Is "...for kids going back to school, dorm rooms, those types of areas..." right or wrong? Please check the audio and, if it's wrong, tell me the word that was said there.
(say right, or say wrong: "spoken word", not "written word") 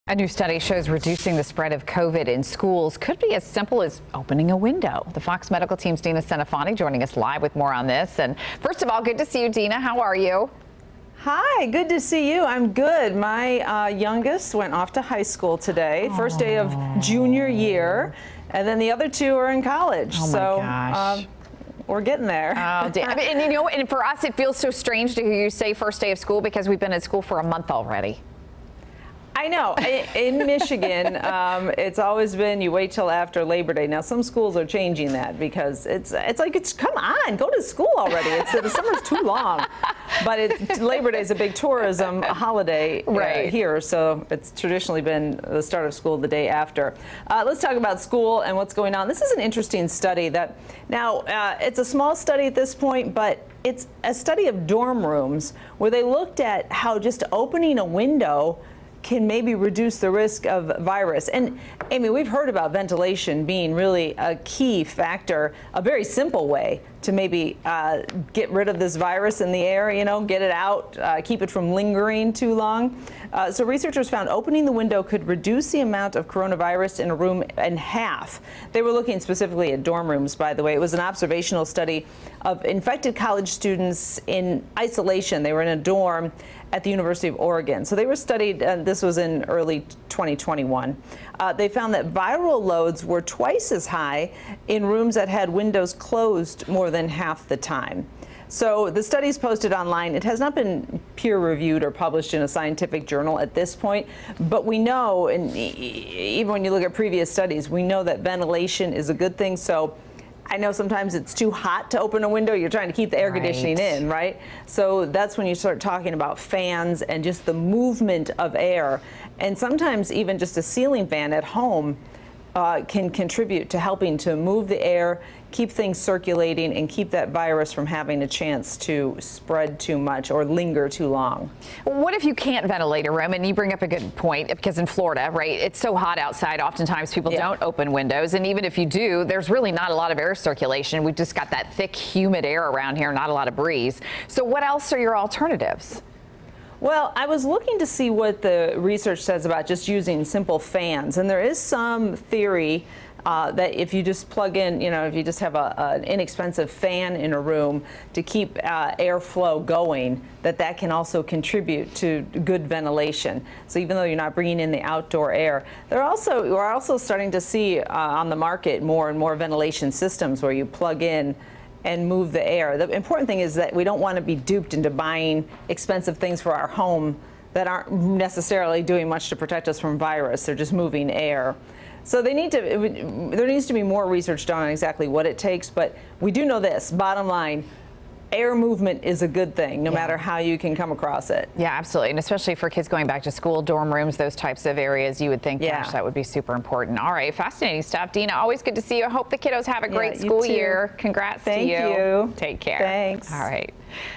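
right.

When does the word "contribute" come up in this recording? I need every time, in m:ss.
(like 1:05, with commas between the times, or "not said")
2:03, 2:41.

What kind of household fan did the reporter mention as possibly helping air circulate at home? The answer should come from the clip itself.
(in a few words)
ceiling fan.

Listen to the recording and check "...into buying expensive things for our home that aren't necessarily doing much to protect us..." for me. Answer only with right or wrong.
right.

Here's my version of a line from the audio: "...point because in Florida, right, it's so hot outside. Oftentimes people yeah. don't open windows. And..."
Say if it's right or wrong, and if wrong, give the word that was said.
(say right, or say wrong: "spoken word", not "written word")
right.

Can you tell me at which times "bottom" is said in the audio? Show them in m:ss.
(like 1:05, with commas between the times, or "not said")
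3:06.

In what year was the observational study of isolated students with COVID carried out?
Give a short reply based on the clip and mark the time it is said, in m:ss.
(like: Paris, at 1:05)
2021, at 1:30.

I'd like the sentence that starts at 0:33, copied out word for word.
Now some schools are changing that because it's it's like it's come on, go to school already.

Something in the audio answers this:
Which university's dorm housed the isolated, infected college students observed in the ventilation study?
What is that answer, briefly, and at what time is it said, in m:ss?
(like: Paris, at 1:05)
University of Oregon, at 1:26.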